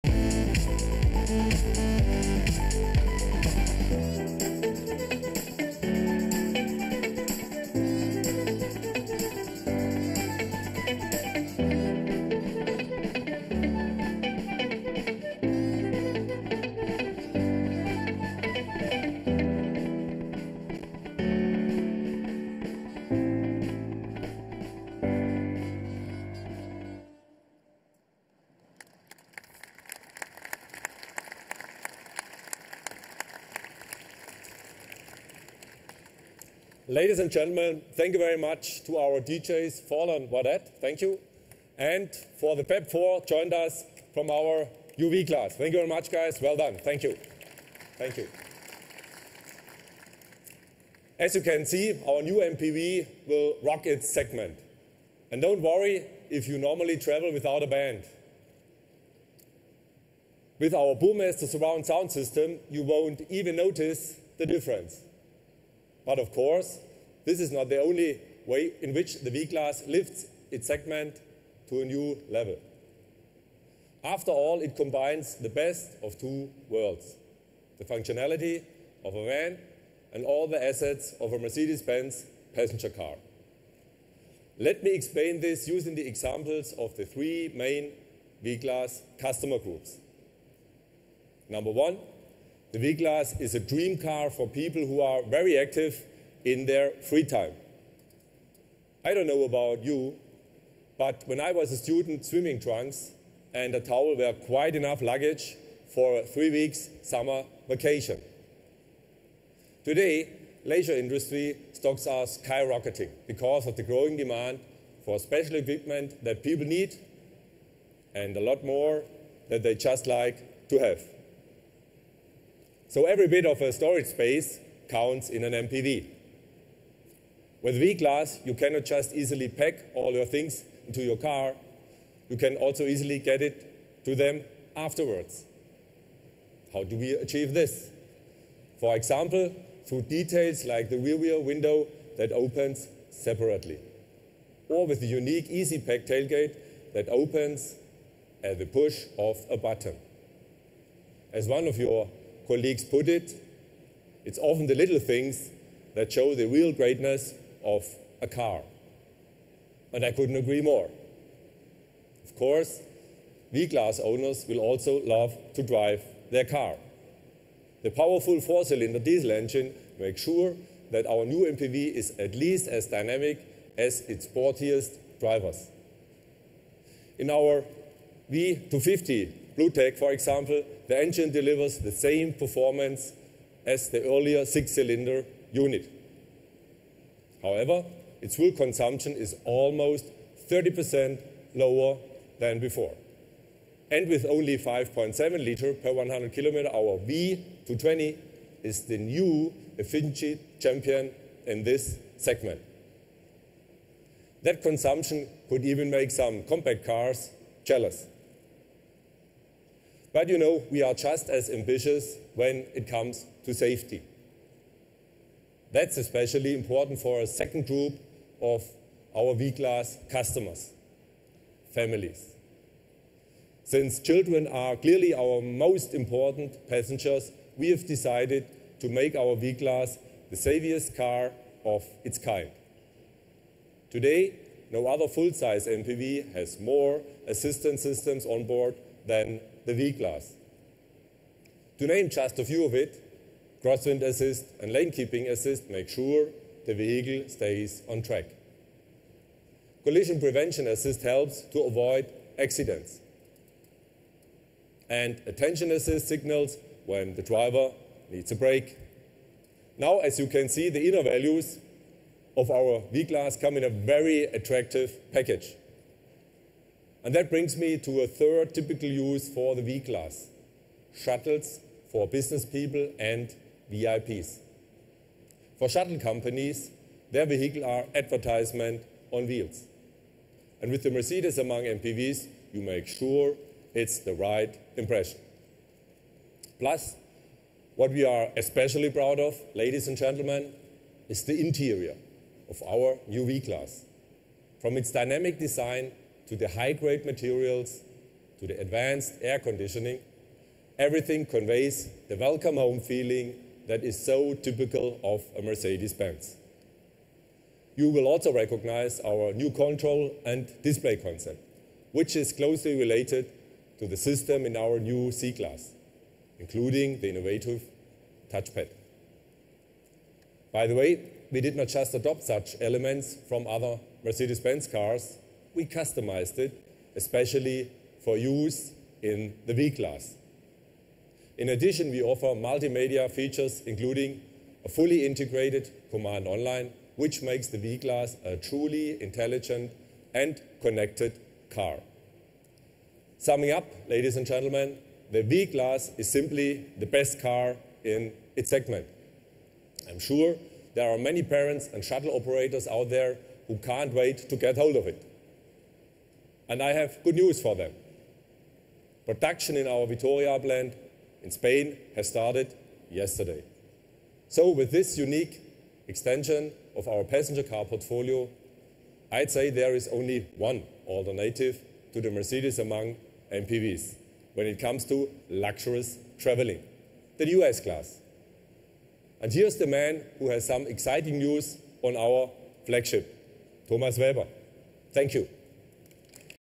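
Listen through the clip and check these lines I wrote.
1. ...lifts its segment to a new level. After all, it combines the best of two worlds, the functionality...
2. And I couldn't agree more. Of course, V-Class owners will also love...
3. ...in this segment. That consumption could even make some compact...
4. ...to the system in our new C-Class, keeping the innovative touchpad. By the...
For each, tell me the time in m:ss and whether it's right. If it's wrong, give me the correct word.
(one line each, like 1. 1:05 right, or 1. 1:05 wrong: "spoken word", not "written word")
1. 1:09 right
2. 2:39 right
3. 3:21 right
4. 5:13 wrong: "including", not "keeping".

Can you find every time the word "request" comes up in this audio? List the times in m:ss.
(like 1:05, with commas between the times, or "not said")
not said.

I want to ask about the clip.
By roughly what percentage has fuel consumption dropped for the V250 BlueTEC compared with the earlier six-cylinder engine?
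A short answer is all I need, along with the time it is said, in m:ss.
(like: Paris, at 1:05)
30%, at 3:10.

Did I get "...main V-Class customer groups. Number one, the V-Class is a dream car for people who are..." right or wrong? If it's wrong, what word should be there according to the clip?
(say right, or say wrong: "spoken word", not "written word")
right.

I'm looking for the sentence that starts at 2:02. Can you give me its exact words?
So every bit of a storage space counts in an MPV.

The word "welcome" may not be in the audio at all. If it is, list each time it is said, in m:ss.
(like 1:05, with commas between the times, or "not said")
5:02.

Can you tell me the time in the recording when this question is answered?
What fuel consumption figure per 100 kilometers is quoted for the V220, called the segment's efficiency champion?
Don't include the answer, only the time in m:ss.
3:14.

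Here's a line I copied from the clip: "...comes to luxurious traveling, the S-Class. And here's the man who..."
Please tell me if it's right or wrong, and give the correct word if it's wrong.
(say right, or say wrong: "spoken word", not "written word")
right.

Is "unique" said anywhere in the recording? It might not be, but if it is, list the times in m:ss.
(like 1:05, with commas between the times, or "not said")
2:25, 6:04.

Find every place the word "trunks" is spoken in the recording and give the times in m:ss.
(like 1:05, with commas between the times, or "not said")
1:42.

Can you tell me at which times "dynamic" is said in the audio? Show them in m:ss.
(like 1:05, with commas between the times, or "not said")
2:52, 4:54.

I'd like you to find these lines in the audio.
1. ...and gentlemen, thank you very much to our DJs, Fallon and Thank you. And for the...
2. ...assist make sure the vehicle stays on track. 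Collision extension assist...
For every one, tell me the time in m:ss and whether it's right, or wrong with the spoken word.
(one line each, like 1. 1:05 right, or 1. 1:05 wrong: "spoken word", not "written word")
1. 0:37 right
2. 4:05 wrong: "prevention", not "extension".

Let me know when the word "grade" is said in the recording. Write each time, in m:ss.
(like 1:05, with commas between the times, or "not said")
4:56.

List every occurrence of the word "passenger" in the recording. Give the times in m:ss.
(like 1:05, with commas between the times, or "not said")
1:22, 3:46, 6:07.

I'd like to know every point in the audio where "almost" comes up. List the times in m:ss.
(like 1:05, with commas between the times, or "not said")
3:09.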